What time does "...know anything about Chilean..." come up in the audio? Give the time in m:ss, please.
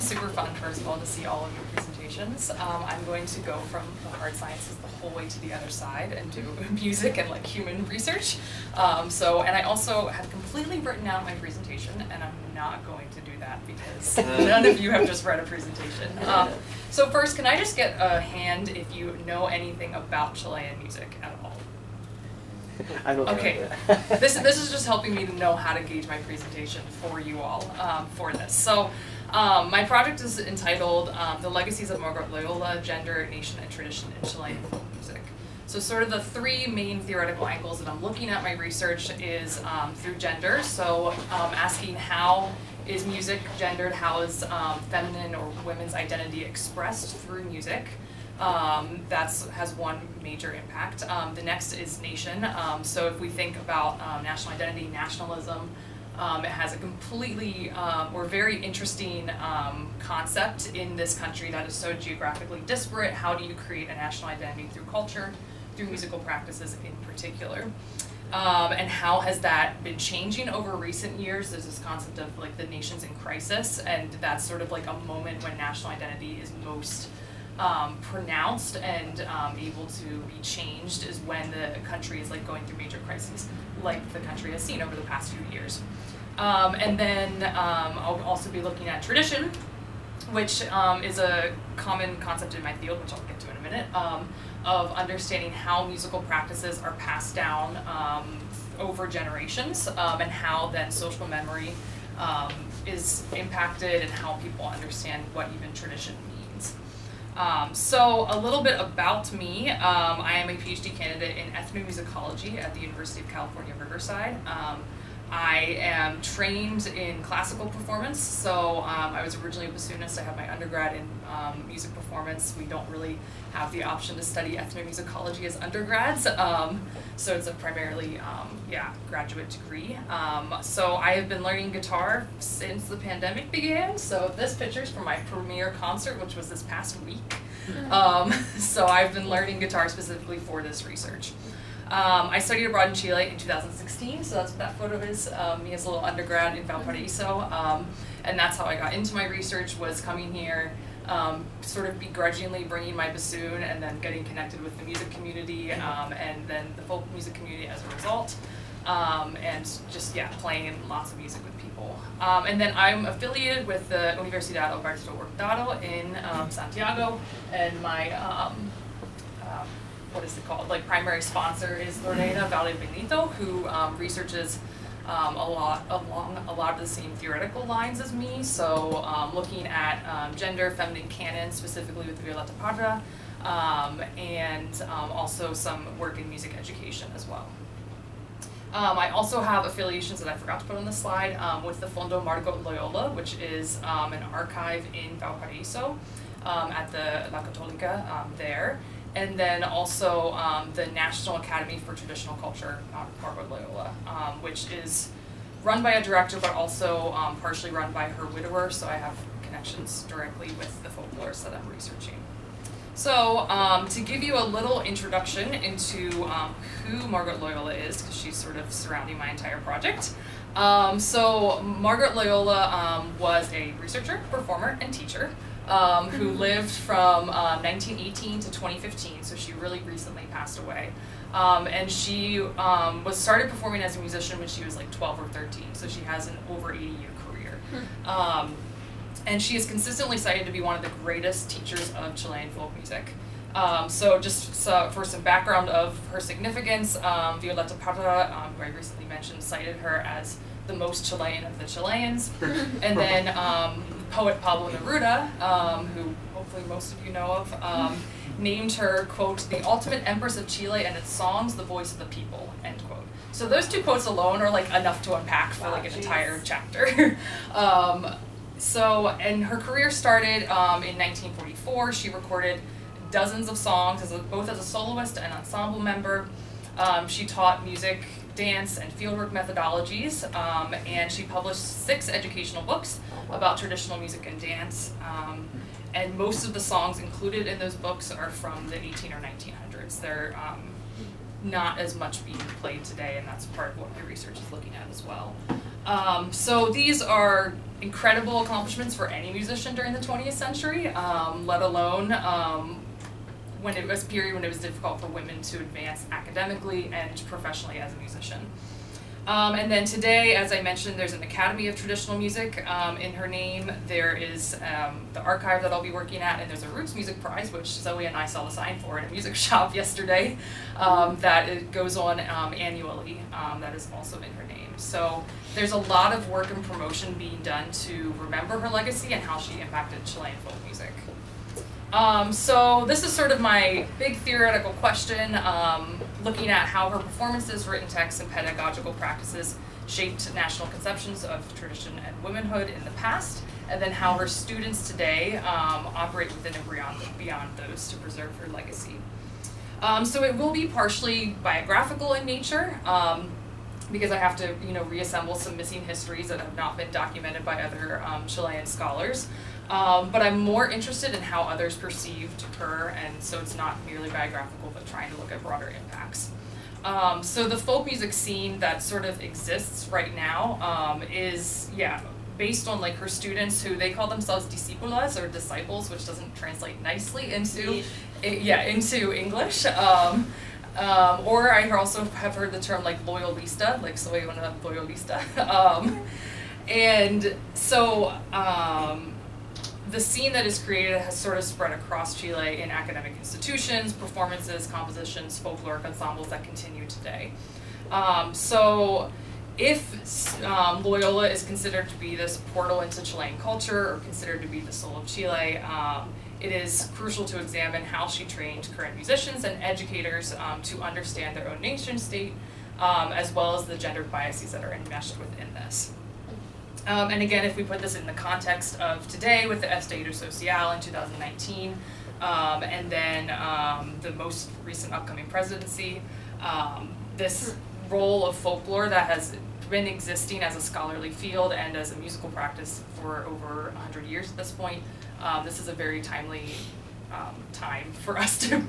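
0:19.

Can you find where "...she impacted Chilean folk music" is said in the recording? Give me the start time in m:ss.
5:29.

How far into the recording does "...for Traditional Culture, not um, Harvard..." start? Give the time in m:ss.
3:21.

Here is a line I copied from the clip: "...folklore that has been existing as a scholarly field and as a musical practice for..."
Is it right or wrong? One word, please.
right.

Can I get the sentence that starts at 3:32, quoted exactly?
So um, to give you a little introduction into um, who Margot Loyola is, because she's sort of surrounding my entire project.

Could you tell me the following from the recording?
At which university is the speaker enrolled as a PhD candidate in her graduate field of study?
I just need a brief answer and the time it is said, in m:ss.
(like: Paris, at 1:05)
University of California, Riverside, at 1:52.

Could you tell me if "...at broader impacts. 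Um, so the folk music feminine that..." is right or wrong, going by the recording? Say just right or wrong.
wrong.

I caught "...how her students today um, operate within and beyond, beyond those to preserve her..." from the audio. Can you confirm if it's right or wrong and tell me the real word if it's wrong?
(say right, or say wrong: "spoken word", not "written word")
right.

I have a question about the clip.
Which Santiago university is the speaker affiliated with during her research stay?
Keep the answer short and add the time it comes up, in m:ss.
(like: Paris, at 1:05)
Universidad Alberto Hurtado, at 2:44.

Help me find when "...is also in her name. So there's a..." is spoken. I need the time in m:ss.
5:23.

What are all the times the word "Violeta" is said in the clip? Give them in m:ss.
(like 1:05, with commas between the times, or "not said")
3:02, 4:07.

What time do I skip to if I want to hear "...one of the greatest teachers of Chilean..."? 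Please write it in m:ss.
4:00.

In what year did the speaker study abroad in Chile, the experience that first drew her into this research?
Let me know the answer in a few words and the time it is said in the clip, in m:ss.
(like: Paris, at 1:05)
2016, at 2:23.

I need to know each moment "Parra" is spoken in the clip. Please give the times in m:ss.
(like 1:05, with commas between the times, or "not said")
3:02, 4:07.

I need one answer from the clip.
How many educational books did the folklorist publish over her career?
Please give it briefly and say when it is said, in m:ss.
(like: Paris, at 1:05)
6, at 4:41.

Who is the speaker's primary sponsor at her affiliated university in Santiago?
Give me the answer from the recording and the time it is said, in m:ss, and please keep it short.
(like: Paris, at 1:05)
Lorena Valdebenito, at 2:52.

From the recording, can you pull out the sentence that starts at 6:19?
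Um, um, or I also have heard the term like loyalista, like soy una loyalista.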